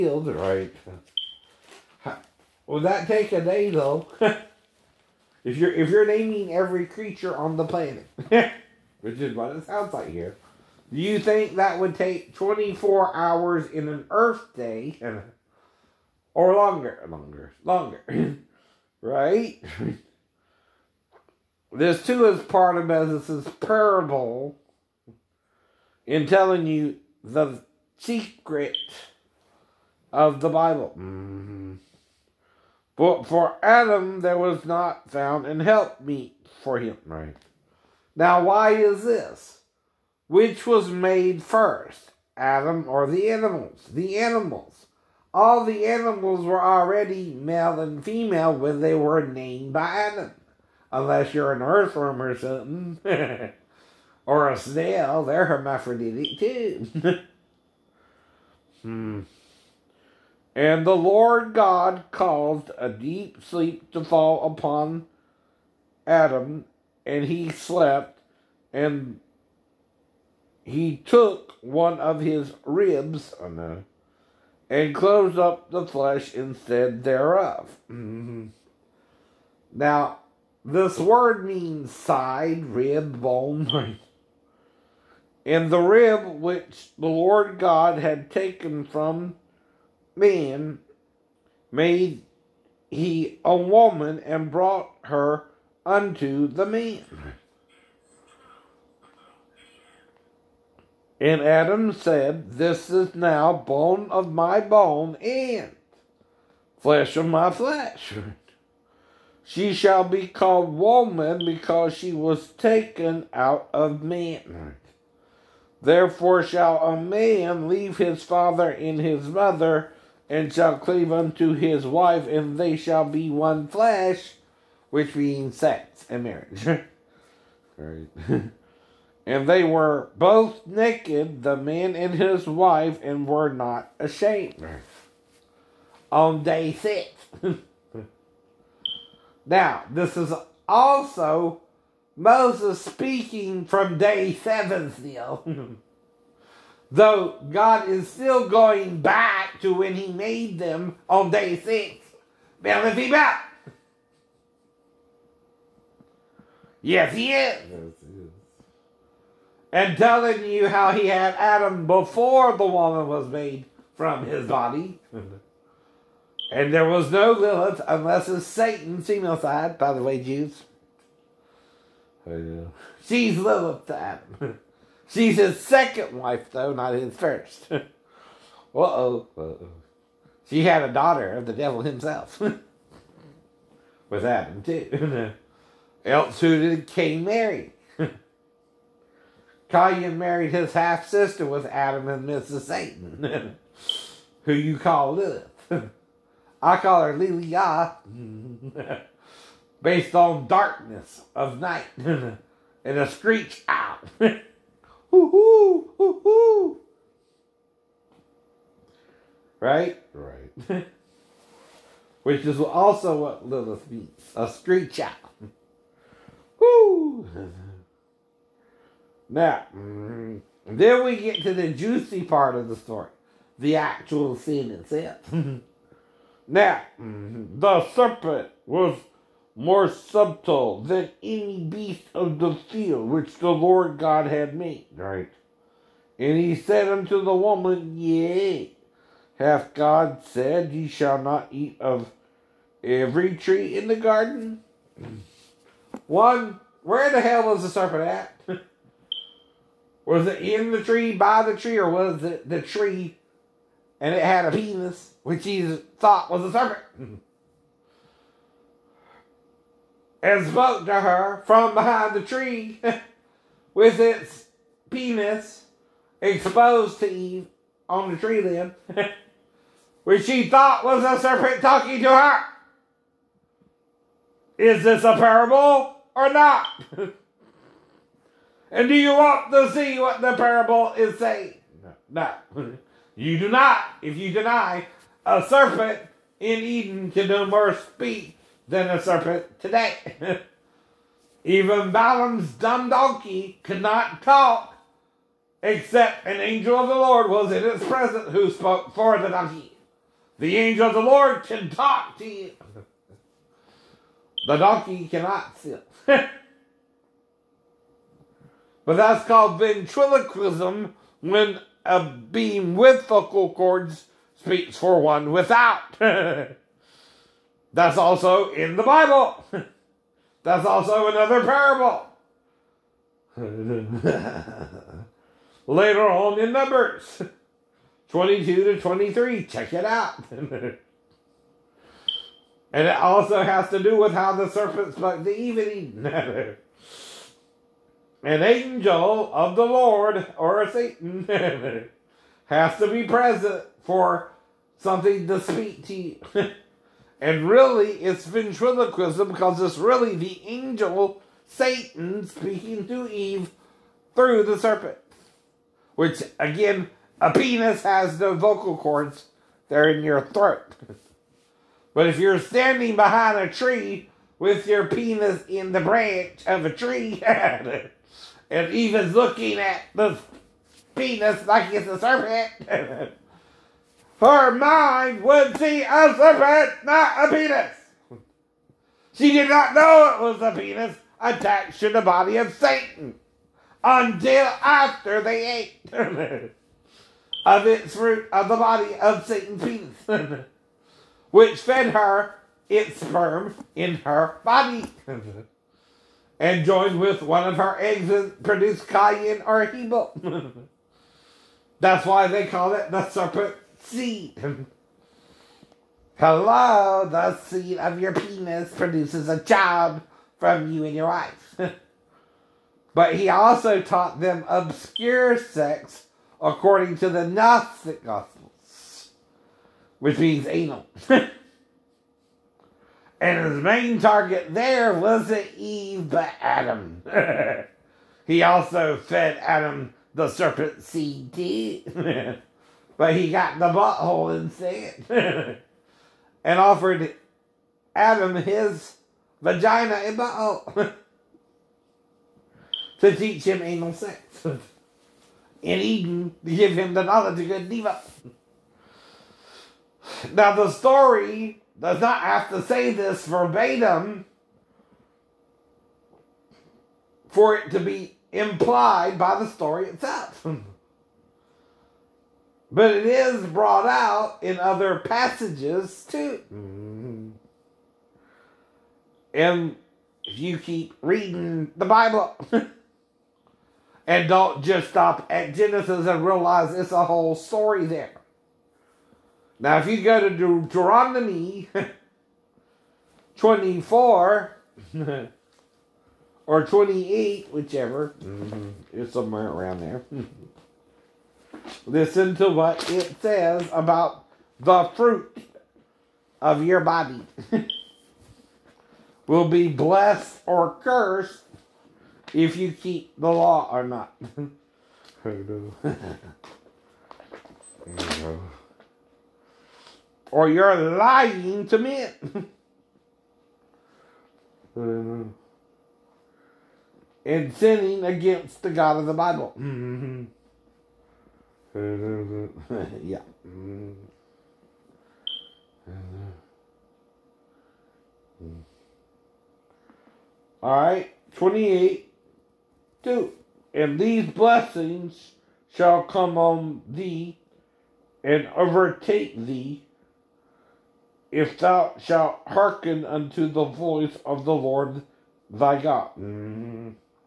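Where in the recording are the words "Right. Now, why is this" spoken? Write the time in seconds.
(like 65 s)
37 s.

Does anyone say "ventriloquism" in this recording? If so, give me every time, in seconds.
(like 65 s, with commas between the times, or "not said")
309 s, 348 s.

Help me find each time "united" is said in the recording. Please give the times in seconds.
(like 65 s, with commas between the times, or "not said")
not said.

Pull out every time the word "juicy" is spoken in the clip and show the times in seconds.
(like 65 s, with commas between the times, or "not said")
221 s.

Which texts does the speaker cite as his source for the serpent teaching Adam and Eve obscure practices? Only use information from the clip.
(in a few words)
Gnostic Gospels.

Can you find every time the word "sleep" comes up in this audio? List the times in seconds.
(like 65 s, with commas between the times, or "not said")
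63 s.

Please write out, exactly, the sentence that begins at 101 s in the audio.
And Adam said, This is now bone of my bone and flesh of my flesh.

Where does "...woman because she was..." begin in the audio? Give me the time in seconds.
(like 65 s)
110 s.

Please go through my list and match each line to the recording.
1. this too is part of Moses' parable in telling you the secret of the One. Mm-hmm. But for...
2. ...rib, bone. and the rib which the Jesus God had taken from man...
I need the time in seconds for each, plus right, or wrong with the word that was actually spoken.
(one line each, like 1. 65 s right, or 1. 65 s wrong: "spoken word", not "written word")
1. 21 s wrong: "Bible", not "One"
2. 82 s wrong: "Lord", not "Jesus".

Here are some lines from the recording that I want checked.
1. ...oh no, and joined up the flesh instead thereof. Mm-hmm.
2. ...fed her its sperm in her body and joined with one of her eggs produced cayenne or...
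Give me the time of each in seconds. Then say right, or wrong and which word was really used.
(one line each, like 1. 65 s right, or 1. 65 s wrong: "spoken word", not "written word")
1. 73 s wrong: "closed", not "joined"
2. 391 s right.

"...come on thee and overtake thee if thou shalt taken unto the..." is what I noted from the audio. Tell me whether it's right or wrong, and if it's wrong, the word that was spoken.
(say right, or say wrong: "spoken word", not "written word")
wrong: "hearken", not "taken".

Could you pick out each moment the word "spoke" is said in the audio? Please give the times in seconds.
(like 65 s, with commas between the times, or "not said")
260 s, 298 s, 334 s.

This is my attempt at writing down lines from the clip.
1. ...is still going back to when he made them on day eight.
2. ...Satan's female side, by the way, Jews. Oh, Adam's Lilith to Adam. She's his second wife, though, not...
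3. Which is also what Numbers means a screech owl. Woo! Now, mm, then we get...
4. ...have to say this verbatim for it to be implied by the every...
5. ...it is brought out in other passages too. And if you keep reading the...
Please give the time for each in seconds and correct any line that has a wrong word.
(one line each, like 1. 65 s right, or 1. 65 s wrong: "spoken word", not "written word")
1. 147 s wrong: "six", not "eight"
2. 168 s wrong: "She", not "Adam"
3. 212 s wrong: "Lilith", not "Numbers"
4. 452 s wrong: "story", not "every"
5. 462 s right.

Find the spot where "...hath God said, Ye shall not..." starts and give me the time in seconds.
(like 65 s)
239 s.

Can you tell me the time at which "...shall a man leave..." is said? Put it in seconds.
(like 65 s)
116 s.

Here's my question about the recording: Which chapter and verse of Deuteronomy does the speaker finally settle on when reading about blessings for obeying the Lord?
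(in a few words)
28:2.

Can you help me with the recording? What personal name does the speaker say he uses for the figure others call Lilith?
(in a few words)
Lilia.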